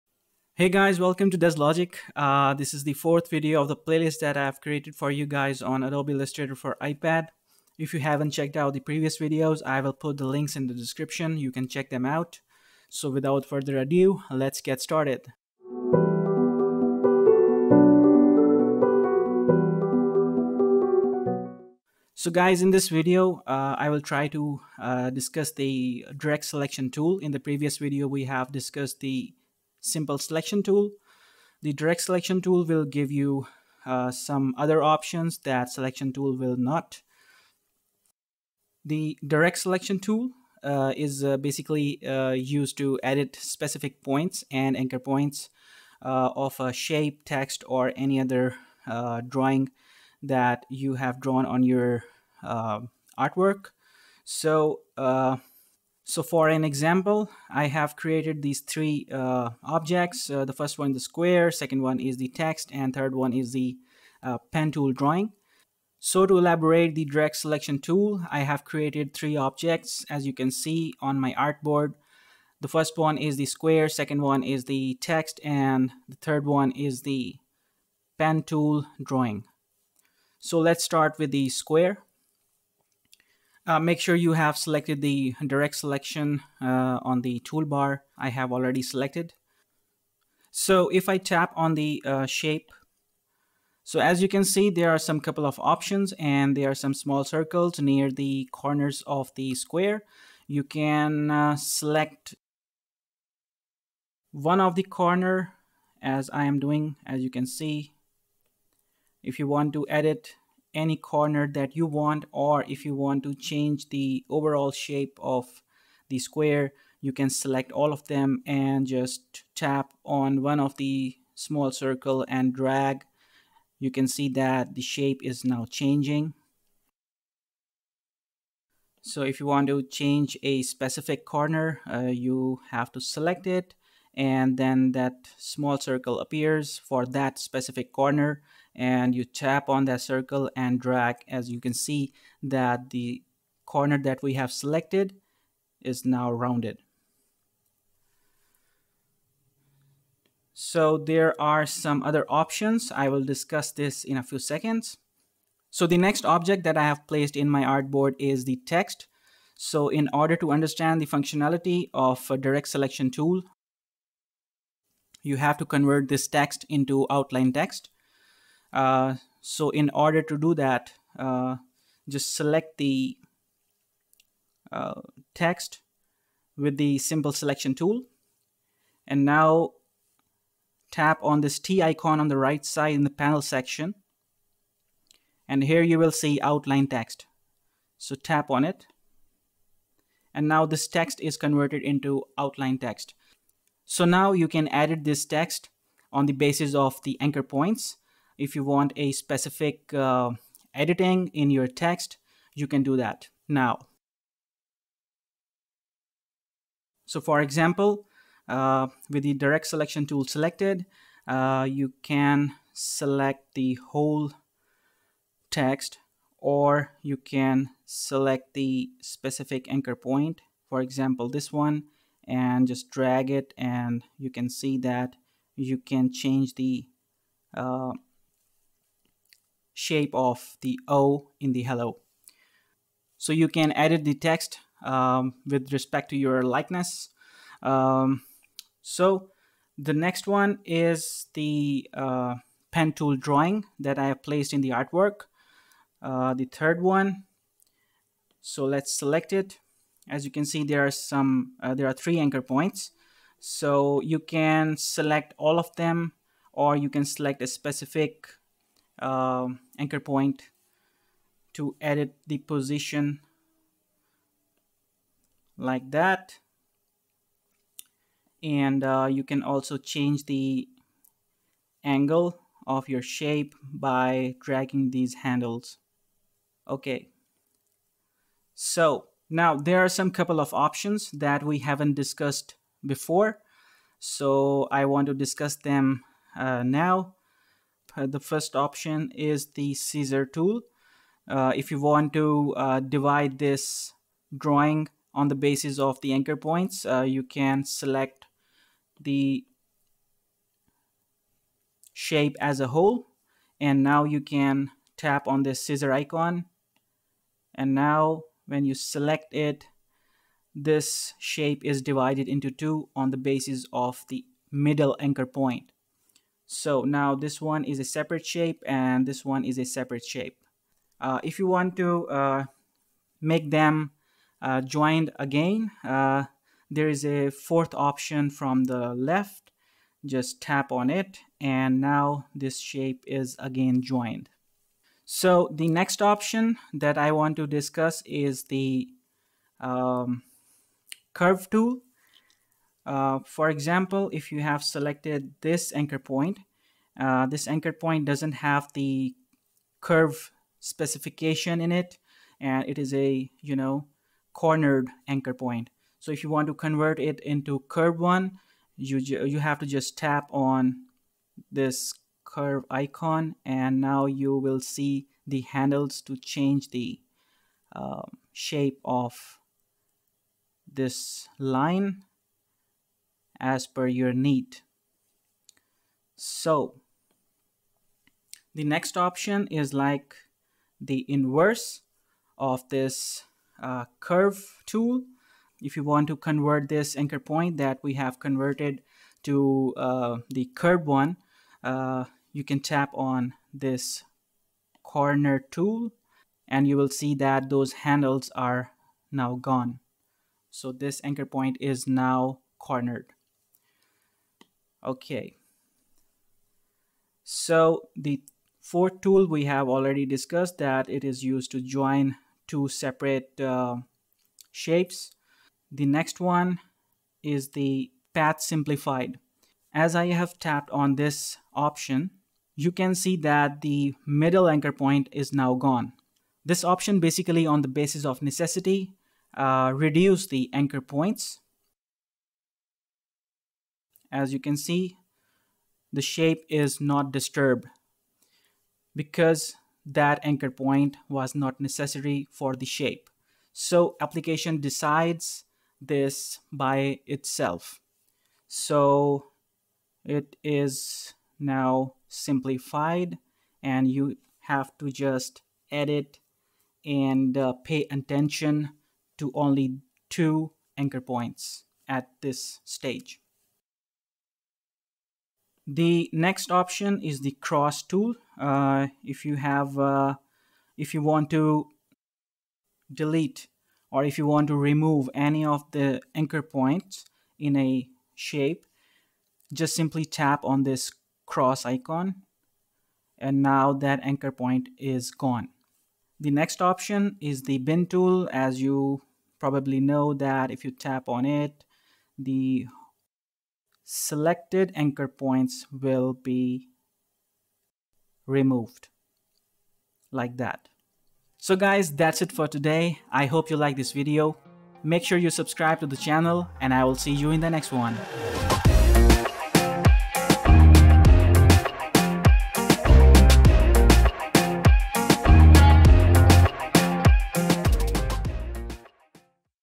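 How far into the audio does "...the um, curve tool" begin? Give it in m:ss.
5:38.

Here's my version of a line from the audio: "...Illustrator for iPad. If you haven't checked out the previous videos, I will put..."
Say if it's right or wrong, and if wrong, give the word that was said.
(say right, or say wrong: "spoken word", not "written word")
right.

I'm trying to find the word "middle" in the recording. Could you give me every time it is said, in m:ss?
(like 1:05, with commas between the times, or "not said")
5:14, 7:04.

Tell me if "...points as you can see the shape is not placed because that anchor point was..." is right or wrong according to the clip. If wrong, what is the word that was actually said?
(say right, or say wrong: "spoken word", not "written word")
wrong: "disturbed", not "placed".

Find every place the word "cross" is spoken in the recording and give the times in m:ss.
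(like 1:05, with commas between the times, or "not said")
7:47, 8:01.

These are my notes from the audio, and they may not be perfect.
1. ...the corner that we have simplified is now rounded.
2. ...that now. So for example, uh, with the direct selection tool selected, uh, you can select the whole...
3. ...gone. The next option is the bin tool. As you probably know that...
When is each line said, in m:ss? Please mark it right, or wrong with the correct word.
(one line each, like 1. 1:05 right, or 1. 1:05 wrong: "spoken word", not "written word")
1. 2:22 wrong: "selected", not "simplified"
2. 3:22 right
3. 8:05 right.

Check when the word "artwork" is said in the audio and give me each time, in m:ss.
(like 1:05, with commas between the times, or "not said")
0:52, 4:04.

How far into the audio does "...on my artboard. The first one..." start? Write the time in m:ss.
1:11.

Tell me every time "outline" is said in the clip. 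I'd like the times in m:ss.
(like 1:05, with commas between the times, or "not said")
2:47, 3:06, 3:12.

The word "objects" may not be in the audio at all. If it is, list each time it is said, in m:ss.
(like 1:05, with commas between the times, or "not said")
0:59, 1:09, 2:36.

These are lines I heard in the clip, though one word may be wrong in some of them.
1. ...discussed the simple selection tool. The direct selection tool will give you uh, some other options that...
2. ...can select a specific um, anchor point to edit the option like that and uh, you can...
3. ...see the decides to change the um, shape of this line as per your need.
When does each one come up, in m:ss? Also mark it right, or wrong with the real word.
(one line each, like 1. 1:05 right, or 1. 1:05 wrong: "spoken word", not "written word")
1. 0:28 right
2. 4:16 wrong: "position", not "option"
3. 6:04 wrong: "handles", not "decides".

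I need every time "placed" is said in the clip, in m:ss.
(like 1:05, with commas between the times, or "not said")
2:37, 4:04.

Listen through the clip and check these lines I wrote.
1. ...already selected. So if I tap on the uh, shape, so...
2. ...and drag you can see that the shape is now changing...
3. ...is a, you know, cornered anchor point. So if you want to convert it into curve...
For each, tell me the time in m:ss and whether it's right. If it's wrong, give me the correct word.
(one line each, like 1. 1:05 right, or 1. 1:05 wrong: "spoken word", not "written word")
1. 1:28 right
2. 2:02 right
3. 5:52 right.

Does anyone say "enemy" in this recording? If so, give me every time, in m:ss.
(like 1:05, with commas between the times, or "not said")
not said.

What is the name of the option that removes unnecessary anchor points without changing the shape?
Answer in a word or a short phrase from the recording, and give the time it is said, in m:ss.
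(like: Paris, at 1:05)
path simplified, at 6:58.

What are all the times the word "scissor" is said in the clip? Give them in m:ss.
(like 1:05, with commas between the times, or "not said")
4:49, 5:05.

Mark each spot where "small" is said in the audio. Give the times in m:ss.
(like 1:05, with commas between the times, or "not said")
1:36, 2:01, 2:15.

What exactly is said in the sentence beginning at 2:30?
So there are some other options.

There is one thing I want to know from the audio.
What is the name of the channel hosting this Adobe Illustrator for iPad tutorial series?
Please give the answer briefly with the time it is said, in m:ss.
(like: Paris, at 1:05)
DezLogic, at 0:01.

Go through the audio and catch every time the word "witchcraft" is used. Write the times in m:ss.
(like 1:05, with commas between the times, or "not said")
not said.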